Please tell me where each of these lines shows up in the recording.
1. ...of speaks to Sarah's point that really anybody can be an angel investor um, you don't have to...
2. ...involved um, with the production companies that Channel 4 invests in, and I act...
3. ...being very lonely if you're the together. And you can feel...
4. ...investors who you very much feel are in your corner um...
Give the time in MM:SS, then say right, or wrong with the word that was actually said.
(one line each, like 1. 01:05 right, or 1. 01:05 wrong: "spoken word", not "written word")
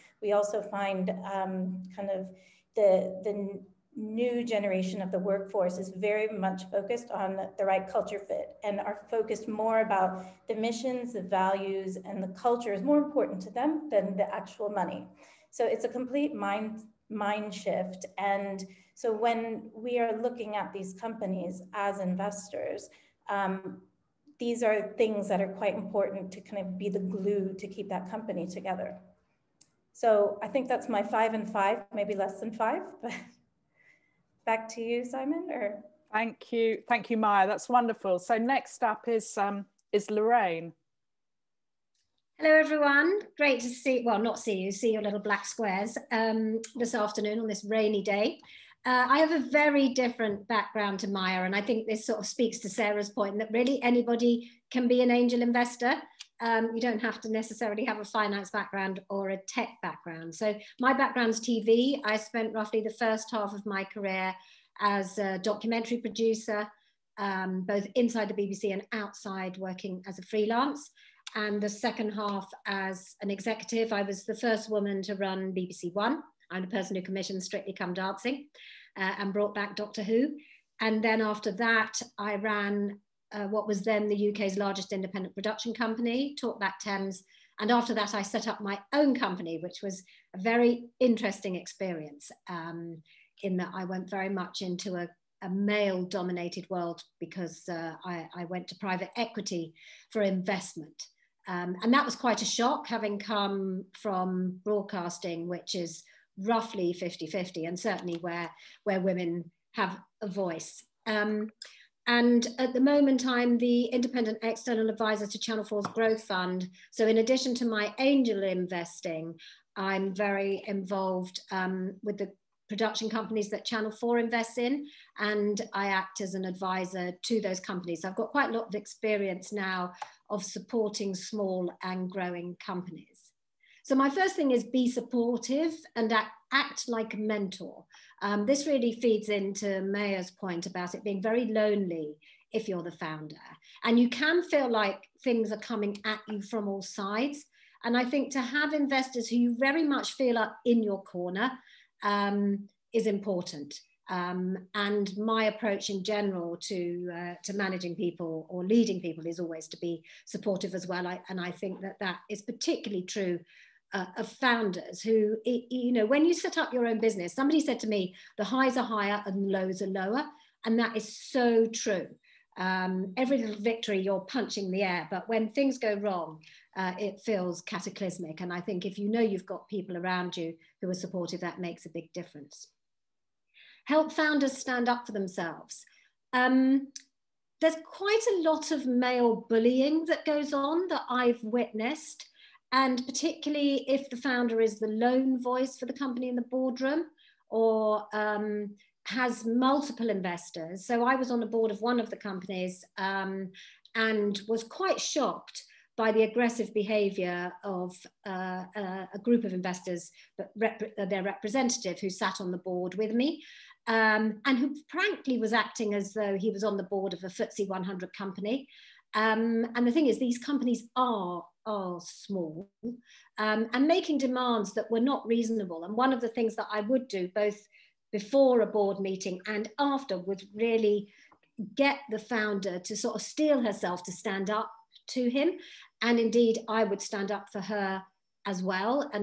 1. 00:52 right
2. 02:00 right
3. 02:21 wrong: "founder", not "together"
4. 02:28 right.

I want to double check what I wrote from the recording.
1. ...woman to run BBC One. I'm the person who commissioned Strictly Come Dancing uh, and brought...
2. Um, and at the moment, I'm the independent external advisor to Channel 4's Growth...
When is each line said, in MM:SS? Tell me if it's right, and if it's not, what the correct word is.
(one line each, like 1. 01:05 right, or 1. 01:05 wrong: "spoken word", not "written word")
1. 01:14 right
2. 01:51 right.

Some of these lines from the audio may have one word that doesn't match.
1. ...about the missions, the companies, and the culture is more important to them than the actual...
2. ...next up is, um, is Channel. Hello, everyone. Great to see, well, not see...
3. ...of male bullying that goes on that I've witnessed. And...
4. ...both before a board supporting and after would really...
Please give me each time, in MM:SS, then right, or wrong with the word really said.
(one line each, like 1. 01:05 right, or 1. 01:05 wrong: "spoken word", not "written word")
1. 00:09 wrong: "values", not "companies"
2. 00:38 wrong: "Lorraine", not "Channel"
3. 03:08 right
4. 03:47 wrong: "meeting", not "supporting".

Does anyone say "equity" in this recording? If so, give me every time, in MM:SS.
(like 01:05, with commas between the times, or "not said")
01:39.